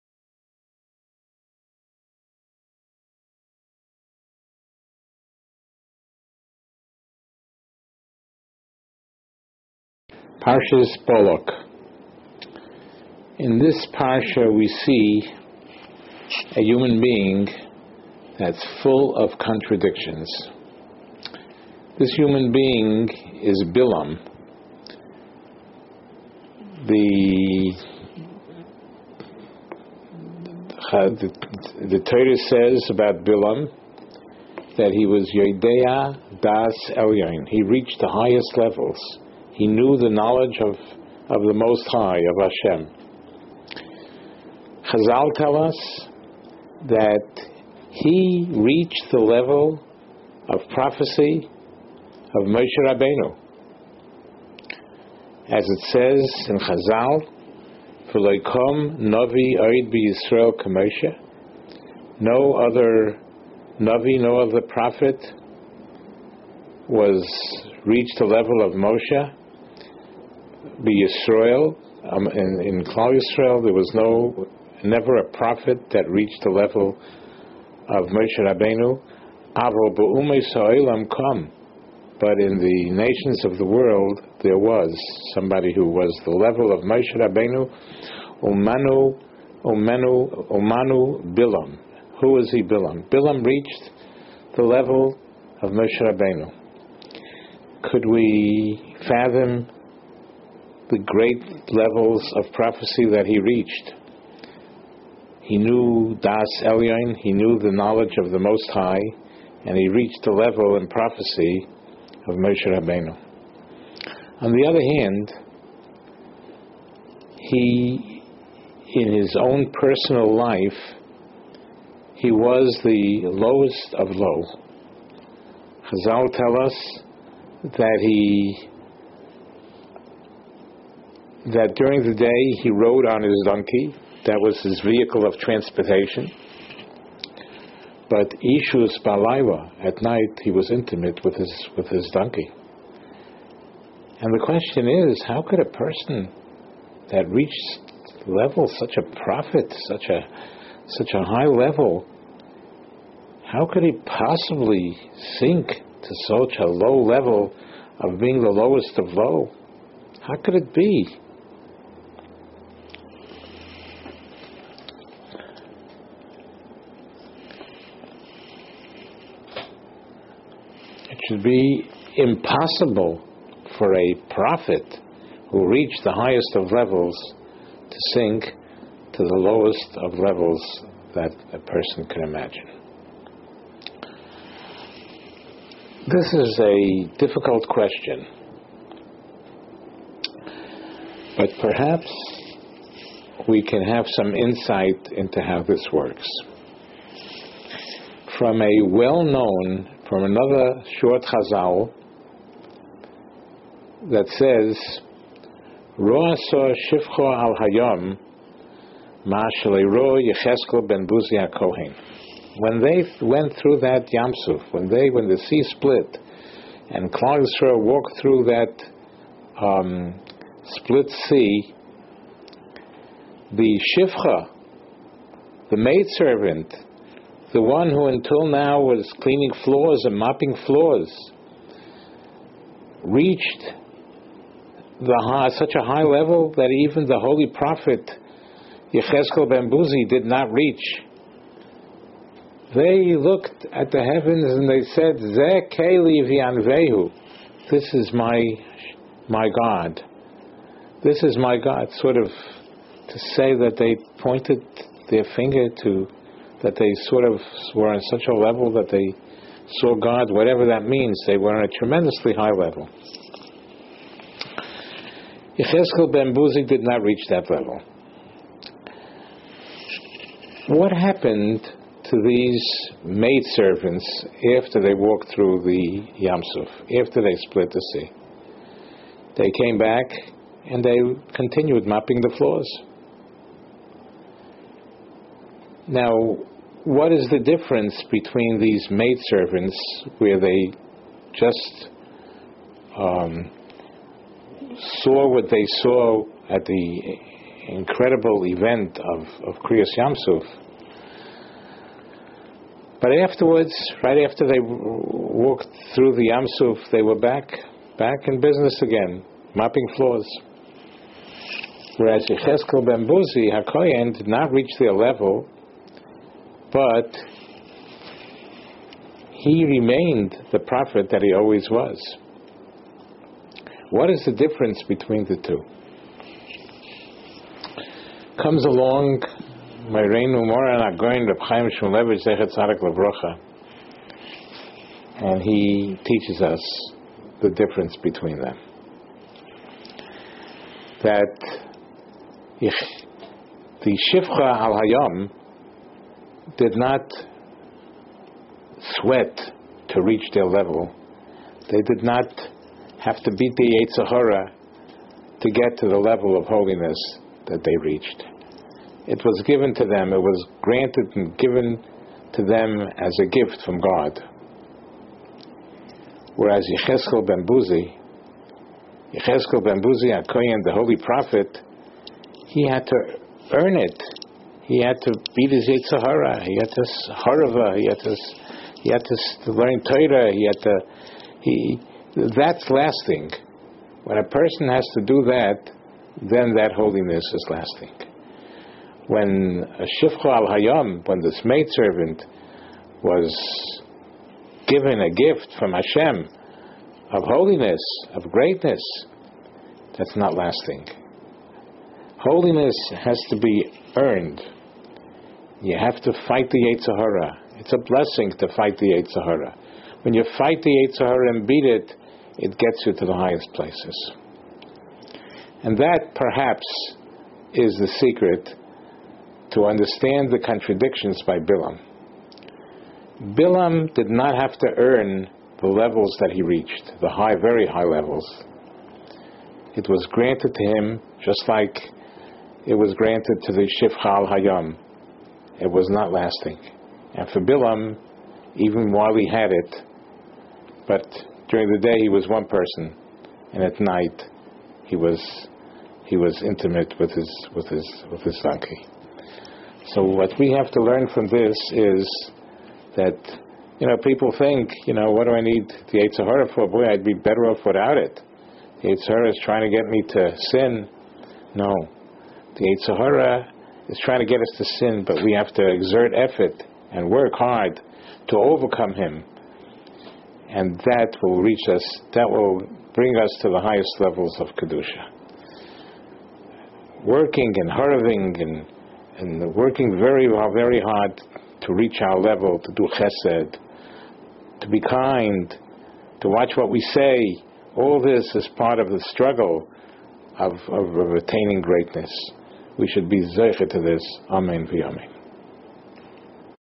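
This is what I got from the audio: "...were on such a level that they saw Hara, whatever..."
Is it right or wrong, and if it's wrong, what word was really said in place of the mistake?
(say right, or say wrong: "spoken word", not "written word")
wrong: "God", not "Hara".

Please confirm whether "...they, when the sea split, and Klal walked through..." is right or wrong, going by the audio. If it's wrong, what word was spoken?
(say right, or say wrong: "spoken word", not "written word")
right.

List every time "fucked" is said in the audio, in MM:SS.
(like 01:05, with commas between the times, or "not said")
not said.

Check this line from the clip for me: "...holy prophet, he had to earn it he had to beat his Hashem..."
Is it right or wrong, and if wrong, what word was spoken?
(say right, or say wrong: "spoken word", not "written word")
wrong: "Yetzer", not "Hashem".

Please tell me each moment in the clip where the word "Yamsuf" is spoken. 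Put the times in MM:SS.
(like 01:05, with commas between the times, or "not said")
03:34, 04:36, 04:59, 05:06.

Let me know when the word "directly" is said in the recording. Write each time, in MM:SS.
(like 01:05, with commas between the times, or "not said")
not said.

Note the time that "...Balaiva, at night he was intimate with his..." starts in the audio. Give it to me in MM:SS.
02:19.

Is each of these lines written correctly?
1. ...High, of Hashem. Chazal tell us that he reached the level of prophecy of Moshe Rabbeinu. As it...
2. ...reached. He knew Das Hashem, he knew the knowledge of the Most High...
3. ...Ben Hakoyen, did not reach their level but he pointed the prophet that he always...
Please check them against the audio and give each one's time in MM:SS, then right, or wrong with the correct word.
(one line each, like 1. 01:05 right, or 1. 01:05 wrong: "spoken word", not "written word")
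1. 00:41 right
2. 01:43 wrong: "Elyon", not "Hashem"
3. 05:12 wrong: "remained", not "pointed".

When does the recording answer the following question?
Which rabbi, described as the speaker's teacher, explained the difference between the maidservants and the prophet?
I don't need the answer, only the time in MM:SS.
05:31.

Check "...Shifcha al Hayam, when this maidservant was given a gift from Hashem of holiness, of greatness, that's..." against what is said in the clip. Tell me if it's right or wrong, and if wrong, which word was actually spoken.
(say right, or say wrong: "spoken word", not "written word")
right.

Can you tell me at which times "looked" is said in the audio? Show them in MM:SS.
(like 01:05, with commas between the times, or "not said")
04:03.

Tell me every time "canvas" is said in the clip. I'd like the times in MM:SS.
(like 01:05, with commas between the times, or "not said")
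not said.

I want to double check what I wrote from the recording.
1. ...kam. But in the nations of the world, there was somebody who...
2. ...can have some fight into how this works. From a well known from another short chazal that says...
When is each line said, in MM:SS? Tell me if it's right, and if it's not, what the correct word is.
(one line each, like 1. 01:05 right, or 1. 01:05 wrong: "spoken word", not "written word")
1. 01:21 right
2. 03:13 wrong: "insight", not "fight".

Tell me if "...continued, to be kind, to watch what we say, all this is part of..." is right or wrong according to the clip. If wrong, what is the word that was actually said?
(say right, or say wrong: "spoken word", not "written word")
wrong: "chesed", not "continued".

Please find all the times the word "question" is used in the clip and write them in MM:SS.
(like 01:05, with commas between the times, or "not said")
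02:24, 03:07.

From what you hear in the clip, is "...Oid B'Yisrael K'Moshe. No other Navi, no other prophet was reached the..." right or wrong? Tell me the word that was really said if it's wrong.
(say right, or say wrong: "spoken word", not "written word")
right.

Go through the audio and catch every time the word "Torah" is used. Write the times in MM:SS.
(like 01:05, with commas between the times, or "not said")
00:32, 06:19.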